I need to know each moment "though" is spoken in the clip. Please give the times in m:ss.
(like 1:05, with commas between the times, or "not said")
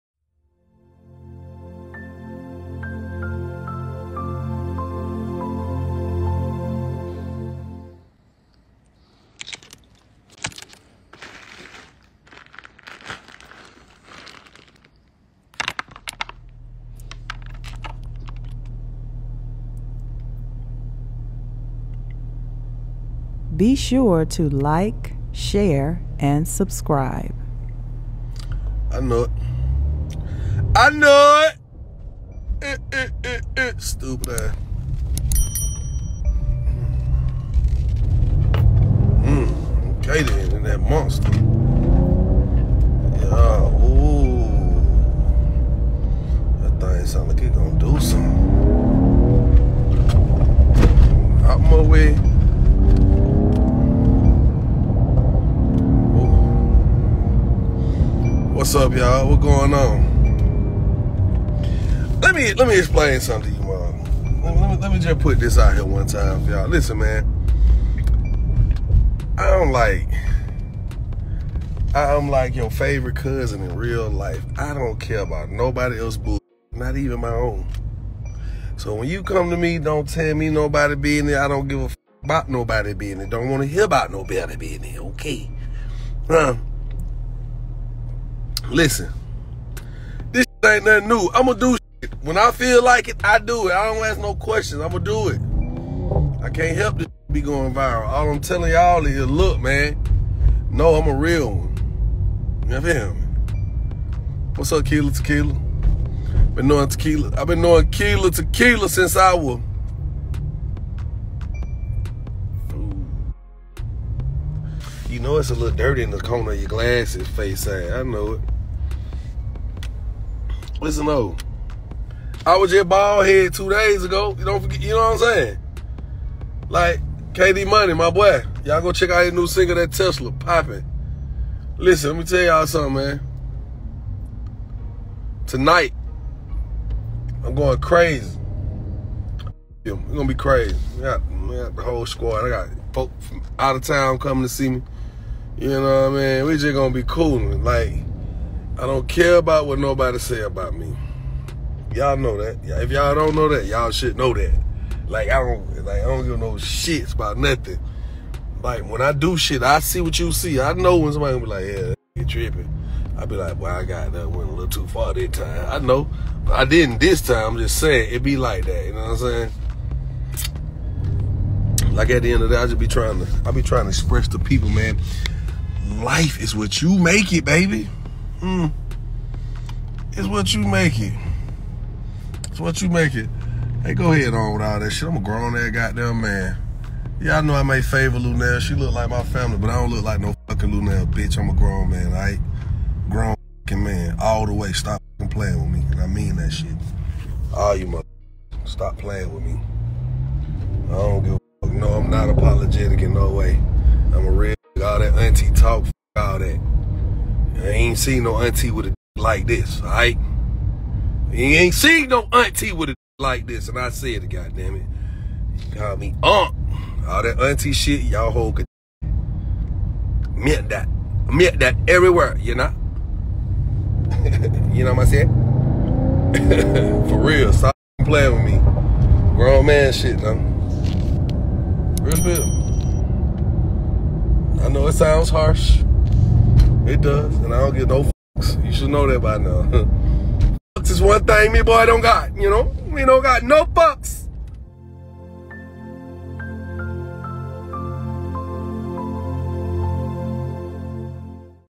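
2:01, 3:50.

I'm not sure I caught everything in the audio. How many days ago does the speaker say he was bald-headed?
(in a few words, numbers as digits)
2.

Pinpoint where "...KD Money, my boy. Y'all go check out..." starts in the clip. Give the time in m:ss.
2:07.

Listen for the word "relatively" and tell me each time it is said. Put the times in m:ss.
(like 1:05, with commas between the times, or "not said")
not said.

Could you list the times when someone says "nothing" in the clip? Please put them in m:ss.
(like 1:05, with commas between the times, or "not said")
1:30, 2:37.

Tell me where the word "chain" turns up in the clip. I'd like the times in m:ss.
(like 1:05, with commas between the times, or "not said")
not said.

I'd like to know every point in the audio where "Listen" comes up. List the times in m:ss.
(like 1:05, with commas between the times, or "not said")
1:06, 1:28, 2:00, 2:11.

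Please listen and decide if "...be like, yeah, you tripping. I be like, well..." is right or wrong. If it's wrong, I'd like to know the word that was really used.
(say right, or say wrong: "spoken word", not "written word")
right.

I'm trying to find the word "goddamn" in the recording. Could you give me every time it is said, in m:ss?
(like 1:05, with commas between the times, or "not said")
3:05, 3:34.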